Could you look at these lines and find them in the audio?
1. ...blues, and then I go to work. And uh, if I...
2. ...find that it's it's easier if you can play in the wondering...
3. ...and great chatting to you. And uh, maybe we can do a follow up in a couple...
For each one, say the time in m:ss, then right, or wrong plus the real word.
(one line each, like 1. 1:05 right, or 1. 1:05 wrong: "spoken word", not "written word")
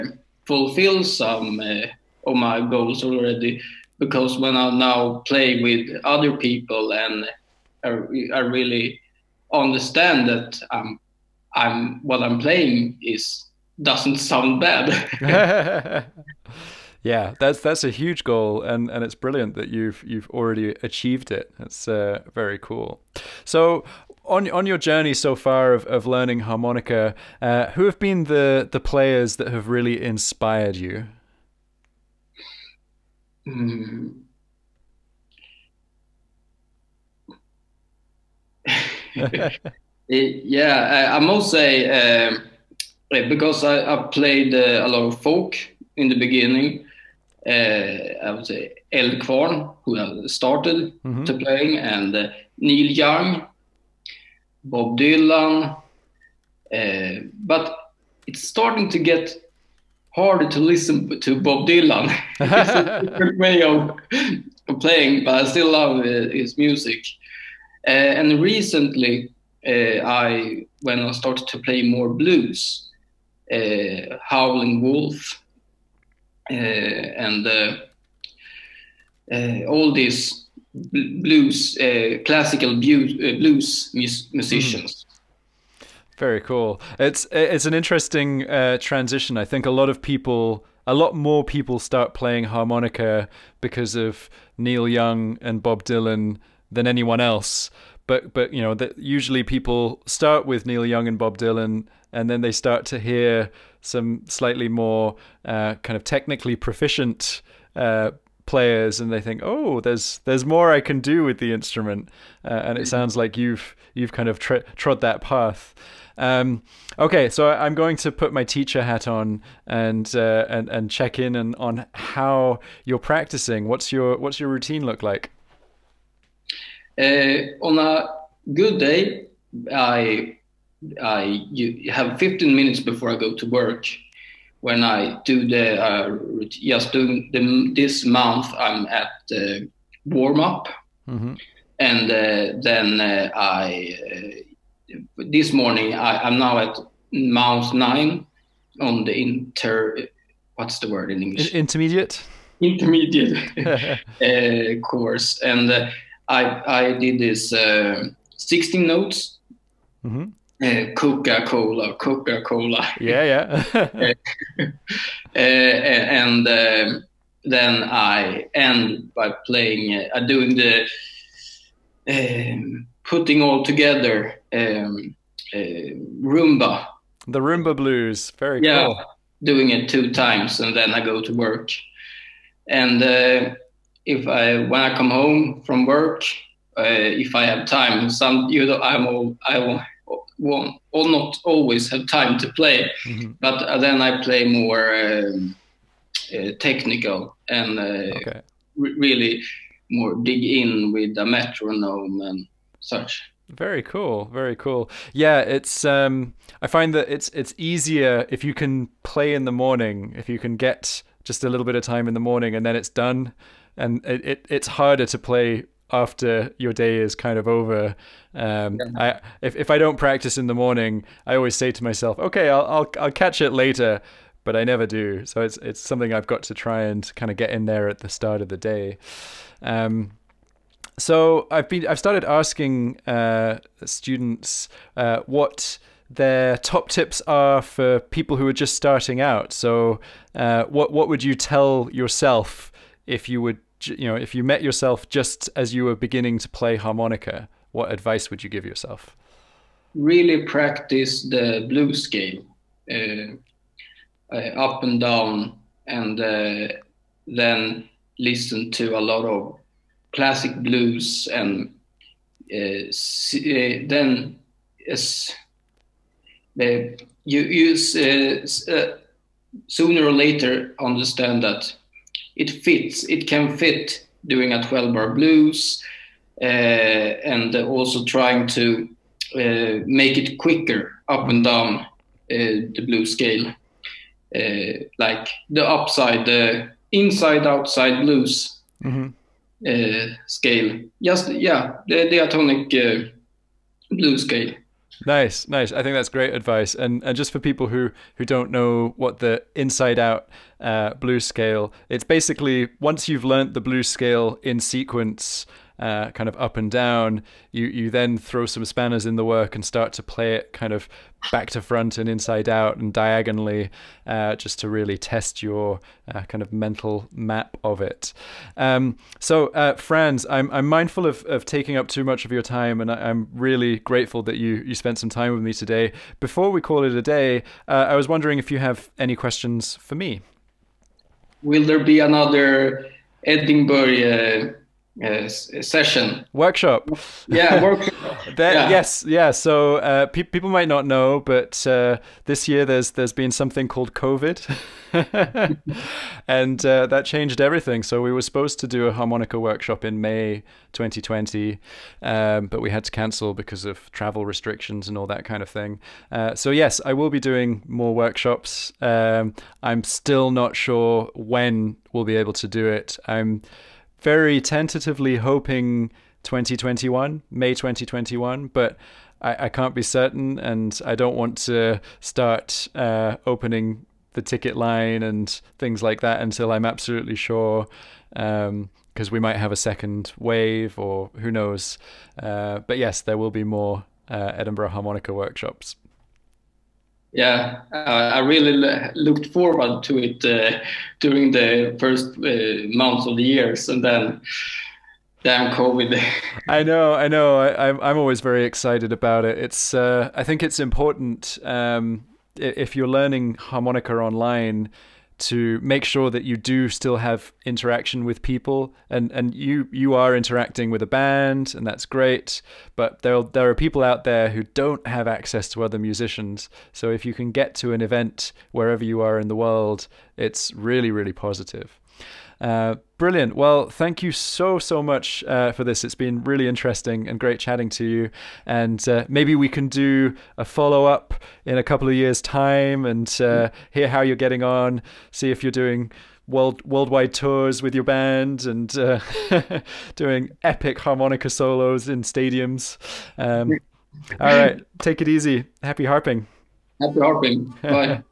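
1. 3:00 wrong: "times", not "blues"
2. 3:26 wrong: "morning", not "wondering"
3. 7:07 right.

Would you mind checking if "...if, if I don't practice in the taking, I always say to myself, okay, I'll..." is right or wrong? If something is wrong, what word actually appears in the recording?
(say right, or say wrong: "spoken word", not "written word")
wrong: "morning", not "taking".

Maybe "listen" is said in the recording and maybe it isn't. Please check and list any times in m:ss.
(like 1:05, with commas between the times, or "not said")
1:00, 4:18.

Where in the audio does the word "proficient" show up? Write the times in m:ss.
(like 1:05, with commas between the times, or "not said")
1:46.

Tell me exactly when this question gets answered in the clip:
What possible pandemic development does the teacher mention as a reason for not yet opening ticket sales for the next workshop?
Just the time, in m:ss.
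6:19.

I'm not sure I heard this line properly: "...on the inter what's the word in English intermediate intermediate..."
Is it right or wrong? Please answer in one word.
right.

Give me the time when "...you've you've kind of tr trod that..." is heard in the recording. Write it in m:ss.
1:53.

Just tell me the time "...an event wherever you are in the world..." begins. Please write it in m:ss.
6:57.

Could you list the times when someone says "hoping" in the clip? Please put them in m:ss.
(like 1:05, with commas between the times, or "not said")
6:05.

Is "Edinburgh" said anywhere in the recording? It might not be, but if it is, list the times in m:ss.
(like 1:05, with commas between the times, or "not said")
5:33, 6:24.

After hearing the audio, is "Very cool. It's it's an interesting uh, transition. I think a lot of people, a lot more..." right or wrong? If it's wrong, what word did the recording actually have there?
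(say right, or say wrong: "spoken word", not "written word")
right.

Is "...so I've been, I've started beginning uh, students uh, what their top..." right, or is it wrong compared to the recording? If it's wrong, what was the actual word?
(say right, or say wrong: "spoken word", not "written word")
wrong: "asking", not "beginning".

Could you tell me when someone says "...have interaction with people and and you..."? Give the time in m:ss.
6:46.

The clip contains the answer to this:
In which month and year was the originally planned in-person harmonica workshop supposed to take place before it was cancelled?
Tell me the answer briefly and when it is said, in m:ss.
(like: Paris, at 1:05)
May 2020, at 5:50.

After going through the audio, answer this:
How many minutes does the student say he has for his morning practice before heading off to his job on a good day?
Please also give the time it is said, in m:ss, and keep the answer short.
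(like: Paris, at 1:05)
15, at 2:12.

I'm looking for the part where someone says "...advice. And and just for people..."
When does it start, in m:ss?
4:56.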